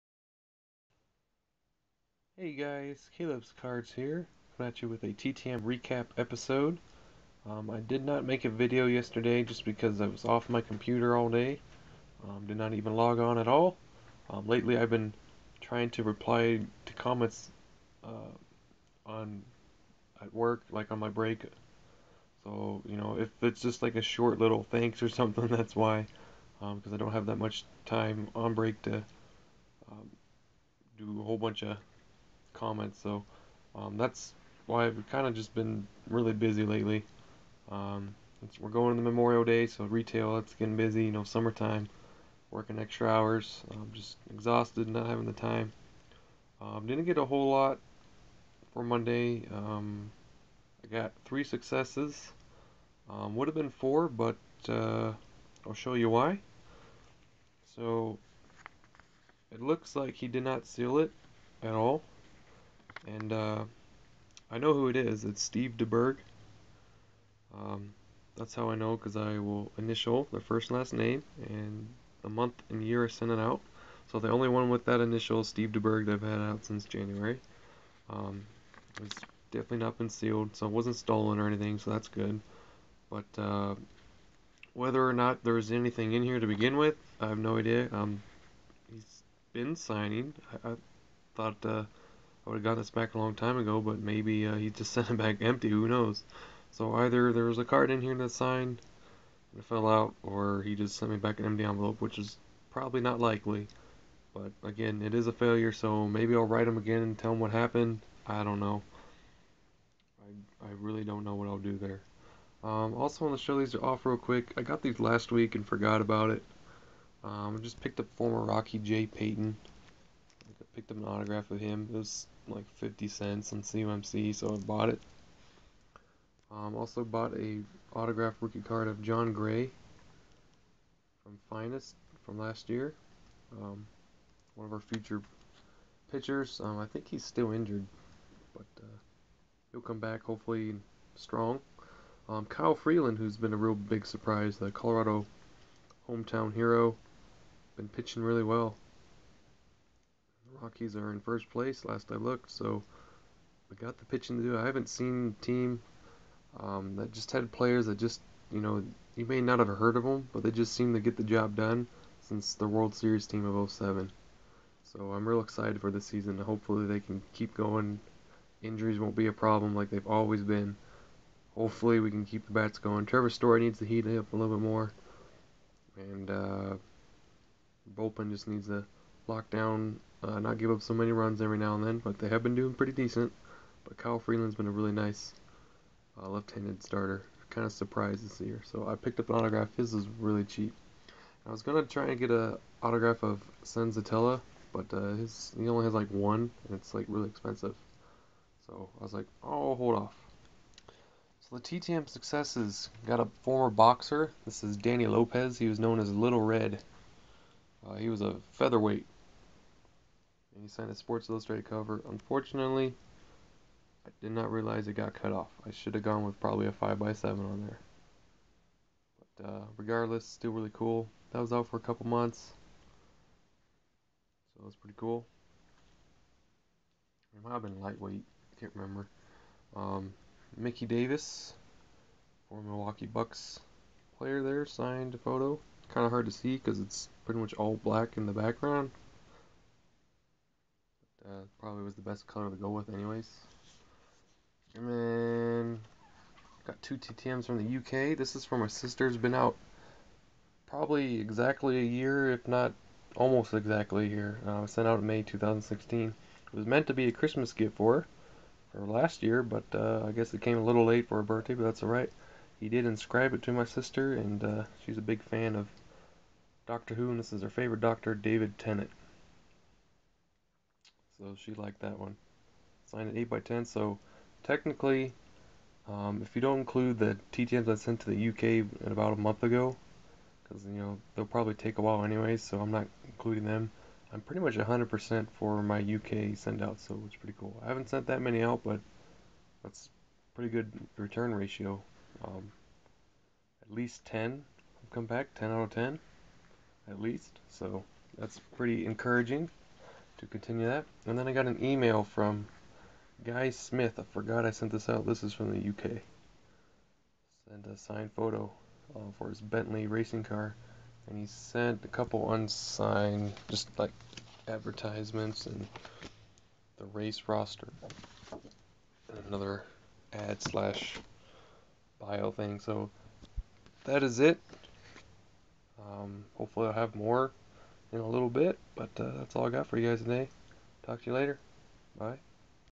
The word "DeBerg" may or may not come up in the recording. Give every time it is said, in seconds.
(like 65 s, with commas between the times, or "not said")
65 s, 75 s.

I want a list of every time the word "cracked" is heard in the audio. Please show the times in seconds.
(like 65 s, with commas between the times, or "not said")
not said.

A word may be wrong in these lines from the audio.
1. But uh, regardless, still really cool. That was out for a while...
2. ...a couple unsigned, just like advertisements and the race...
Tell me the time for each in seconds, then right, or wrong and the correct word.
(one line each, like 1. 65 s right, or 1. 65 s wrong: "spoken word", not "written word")
1. 219 s wrong: "couple", not "while"
2. 311 s right.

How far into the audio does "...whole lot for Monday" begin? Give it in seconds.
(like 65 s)
47 s.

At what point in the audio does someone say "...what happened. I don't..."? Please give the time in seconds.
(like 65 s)
107 s.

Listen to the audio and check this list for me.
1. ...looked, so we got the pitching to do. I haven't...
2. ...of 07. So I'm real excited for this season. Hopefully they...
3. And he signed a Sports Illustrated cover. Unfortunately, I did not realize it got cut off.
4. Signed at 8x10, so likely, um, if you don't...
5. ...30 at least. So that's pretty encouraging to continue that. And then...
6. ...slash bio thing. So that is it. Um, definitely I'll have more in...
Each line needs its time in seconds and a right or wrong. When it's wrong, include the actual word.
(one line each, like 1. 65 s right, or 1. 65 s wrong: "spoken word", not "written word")
1. 152 s right
2. 163 s right
3. 210 s right
4. 272 s wrong: "technically", not "likely"
5. 295 s wrong: "10", not "30"
6. 320 s wrong: "hopefully", not "definitely".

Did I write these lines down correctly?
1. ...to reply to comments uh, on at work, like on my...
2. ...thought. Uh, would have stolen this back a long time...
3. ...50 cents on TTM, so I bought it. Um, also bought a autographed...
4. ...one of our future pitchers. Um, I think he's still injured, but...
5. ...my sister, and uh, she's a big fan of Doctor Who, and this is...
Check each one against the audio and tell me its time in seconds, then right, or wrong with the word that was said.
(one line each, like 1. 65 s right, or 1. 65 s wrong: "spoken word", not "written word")
1. 15 s right
2. 91 s wrong: "gotten", not "stolen"
3. 122 s wrong: "CMC", not "TTM"
4. 134 s right
5. 263 s right.